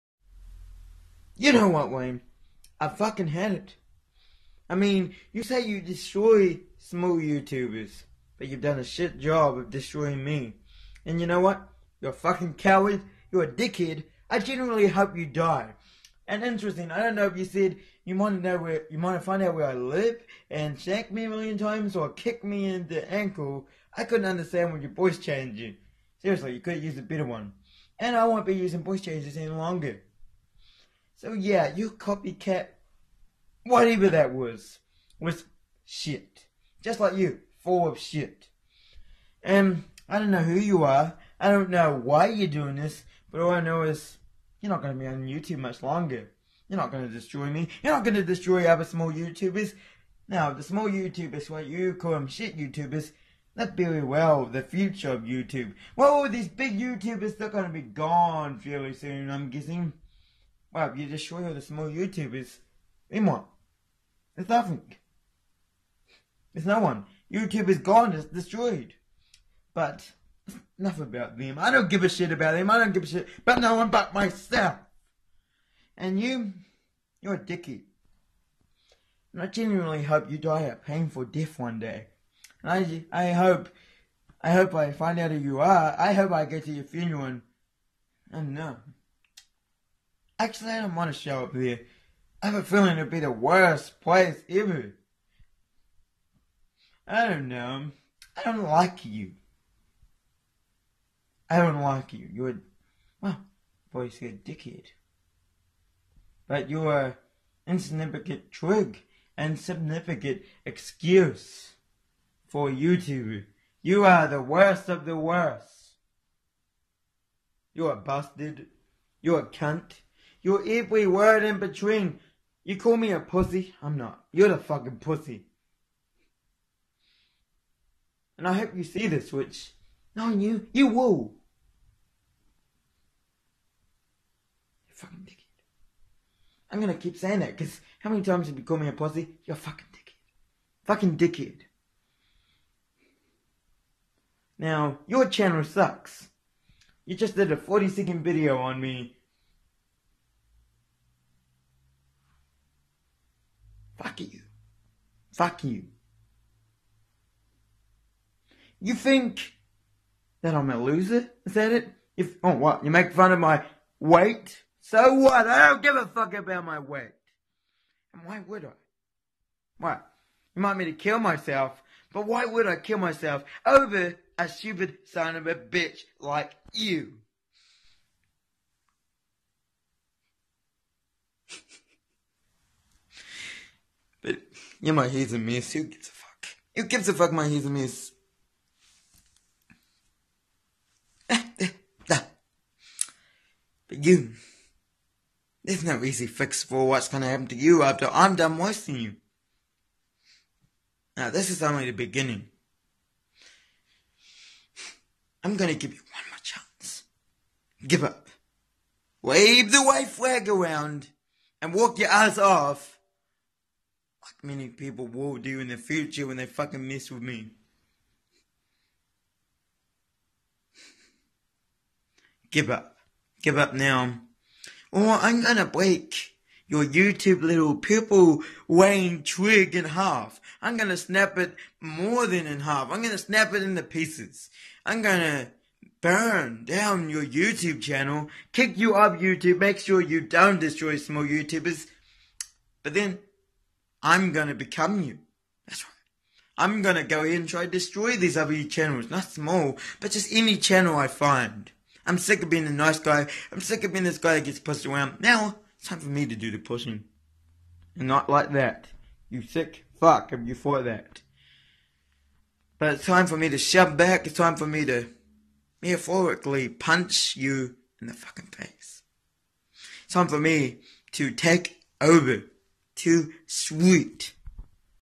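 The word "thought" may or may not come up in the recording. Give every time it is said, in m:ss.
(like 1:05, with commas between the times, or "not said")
4:20.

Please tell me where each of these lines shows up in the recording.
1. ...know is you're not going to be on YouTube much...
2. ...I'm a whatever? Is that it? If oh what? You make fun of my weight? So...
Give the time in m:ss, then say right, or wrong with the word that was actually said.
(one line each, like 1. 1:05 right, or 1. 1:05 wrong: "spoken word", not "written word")
1. 0:43 right
2. 2:40 wrong: "loser", not "whatever".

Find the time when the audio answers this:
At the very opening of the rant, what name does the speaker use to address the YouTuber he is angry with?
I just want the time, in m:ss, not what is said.
0:01.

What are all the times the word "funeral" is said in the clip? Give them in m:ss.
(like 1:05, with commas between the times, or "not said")
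1:26.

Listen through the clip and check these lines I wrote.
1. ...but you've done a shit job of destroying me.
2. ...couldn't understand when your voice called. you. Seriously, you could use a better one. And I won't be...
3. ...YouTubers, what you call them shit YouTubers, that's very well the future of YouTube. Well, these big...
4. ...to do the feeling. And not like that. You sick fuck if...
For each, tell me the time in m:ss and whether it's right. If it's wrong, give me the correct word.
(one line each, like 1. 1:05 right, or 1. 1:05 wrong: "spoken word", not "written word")
1. 0:08 right
2. 0:24 wrong: "changed", not "called"
3. 0:50 right
4. 4:16 wrong: "pushing", not "feeling".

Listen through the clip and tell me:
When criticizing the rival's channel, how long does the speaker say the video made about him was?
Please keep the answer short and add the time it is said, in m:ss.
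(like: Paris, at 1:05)
40 seconds, at 2:27.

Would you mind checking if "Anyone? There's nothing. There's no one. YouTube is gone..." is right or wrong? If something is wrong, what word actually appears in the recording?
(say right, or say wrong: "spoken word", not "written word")
right.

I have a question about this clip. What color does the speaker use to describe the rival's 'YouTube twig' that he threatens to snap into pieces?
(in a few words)
purple.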